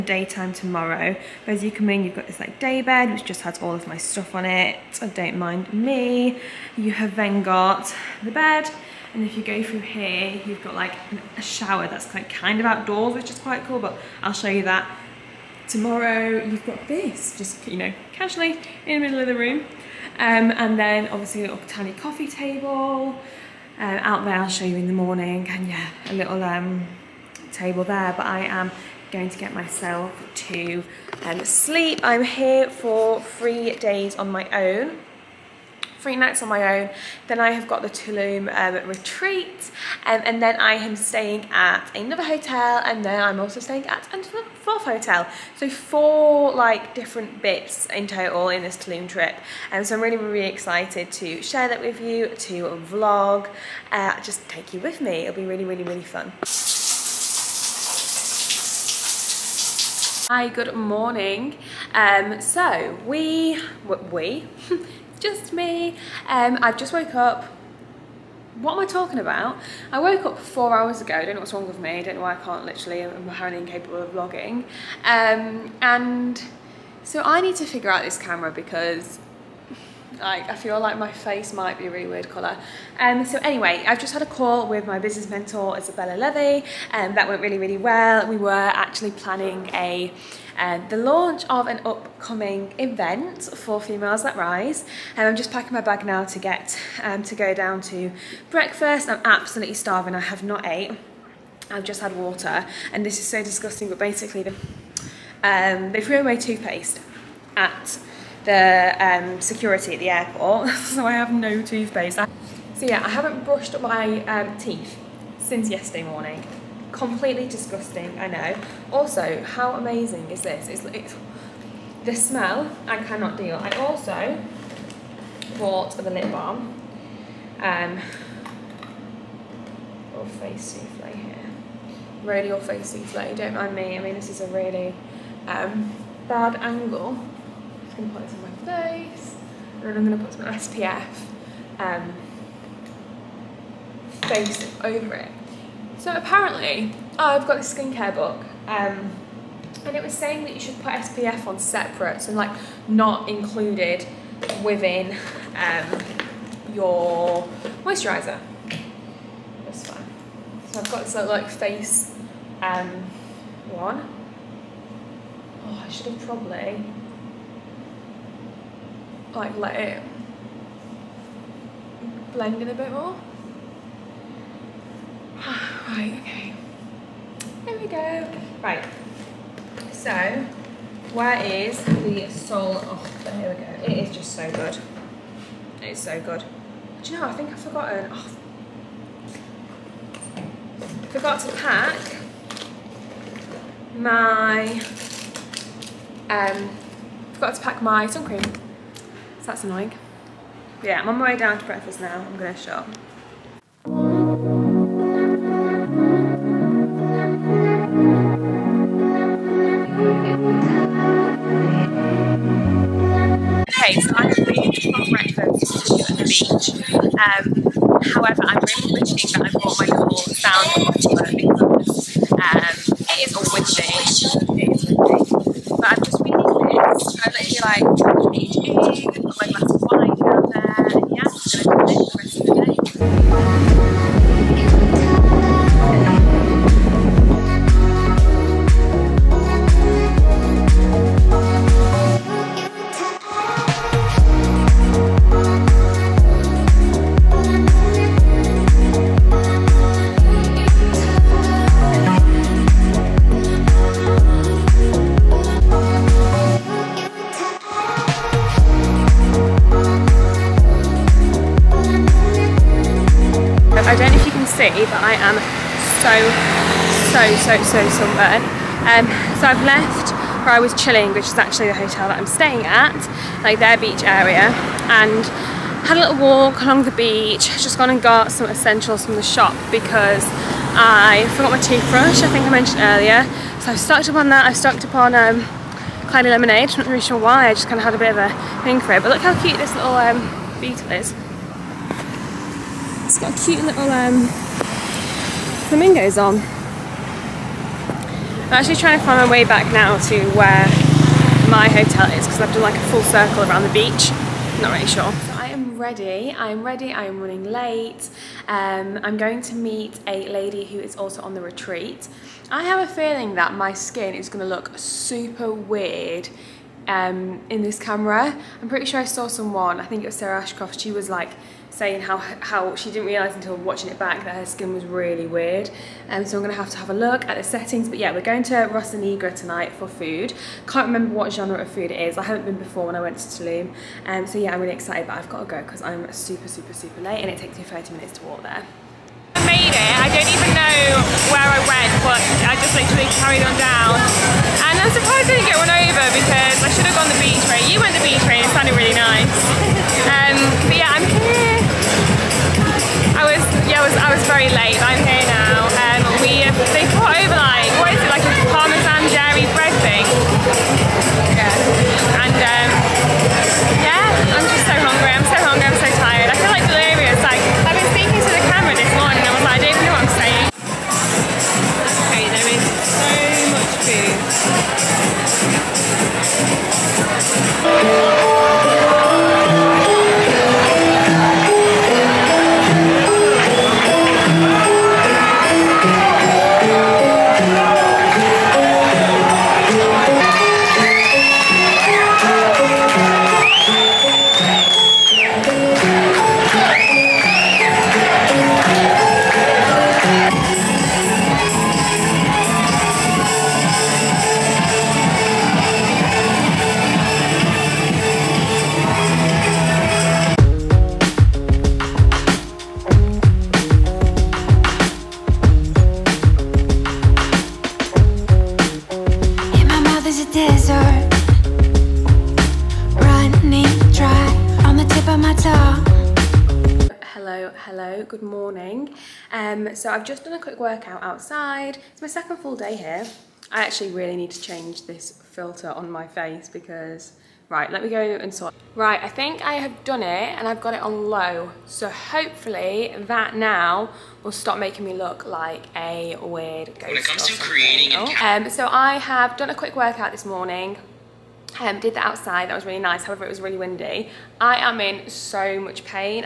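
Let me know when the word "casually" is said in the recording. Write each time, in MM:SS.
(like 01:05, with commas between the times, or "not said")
00:18.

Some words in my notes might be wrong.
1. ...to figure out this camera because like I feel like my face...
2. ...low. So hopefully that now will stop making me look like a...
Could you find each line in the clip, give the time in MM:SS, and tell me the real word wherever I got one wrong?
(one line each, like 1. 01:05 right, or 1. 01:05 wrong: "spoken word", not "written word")
1. 01:17 right
2. 07:21 right.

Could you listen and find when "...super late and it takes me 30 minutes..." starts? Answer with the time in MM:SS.
05:36.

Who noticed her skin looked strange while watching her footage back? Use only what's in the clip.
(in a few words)
Sarah Ashcroft.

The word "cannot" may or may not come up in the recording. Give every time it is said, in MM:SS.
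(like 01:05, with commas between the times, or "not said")
02:03.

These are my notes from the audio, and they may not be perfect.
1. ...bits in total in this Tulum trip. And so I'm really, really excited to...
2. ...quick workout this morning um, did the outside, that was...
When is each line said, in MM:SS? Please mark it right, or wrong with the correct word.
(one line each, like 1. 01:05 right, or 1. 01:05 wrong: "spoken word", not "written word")
1. 00:47 right
2. 07:29 right.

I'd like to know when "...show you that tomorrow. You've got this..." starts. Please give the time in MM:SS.
00:14.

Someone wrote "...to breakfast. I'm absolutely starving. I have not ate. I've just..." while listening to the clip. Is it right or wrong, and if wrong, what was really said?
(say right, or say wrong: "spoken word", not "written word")
right.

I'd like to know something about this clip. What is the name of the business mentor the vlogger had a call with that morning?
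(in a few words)
Isabella Levy.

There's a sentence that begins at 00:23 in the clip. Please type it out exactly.
Uh, out there, I'll show you in the morning.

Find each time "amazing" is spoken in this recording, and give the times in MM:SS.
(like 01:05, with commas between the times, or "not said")
01:59.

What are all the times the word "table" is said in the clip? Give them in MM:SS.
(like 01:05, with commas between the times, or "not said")
00:22, 00:27.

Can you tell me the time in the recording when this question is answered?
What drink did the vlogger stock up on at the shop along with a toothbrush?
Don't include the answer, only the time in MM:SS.
04:46.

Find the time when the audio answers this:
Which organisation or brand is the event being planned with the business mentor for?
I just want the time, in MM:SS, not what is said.
01:33.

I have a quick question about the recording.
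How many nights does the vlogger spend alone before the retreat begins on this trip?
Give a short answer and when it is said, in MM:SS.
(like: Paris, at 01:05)
3, at 00:36.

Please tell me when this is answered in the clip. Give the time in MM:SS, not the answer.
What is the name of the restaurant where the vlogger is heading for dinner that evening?
05:28.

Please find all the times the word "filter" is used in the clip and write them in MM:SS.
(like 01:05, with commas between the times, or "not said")
07:15.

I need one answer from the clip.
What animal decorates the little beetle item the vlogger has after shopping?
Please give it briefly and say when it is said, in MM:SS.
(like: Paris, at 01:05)
Flamingos, at 04:55.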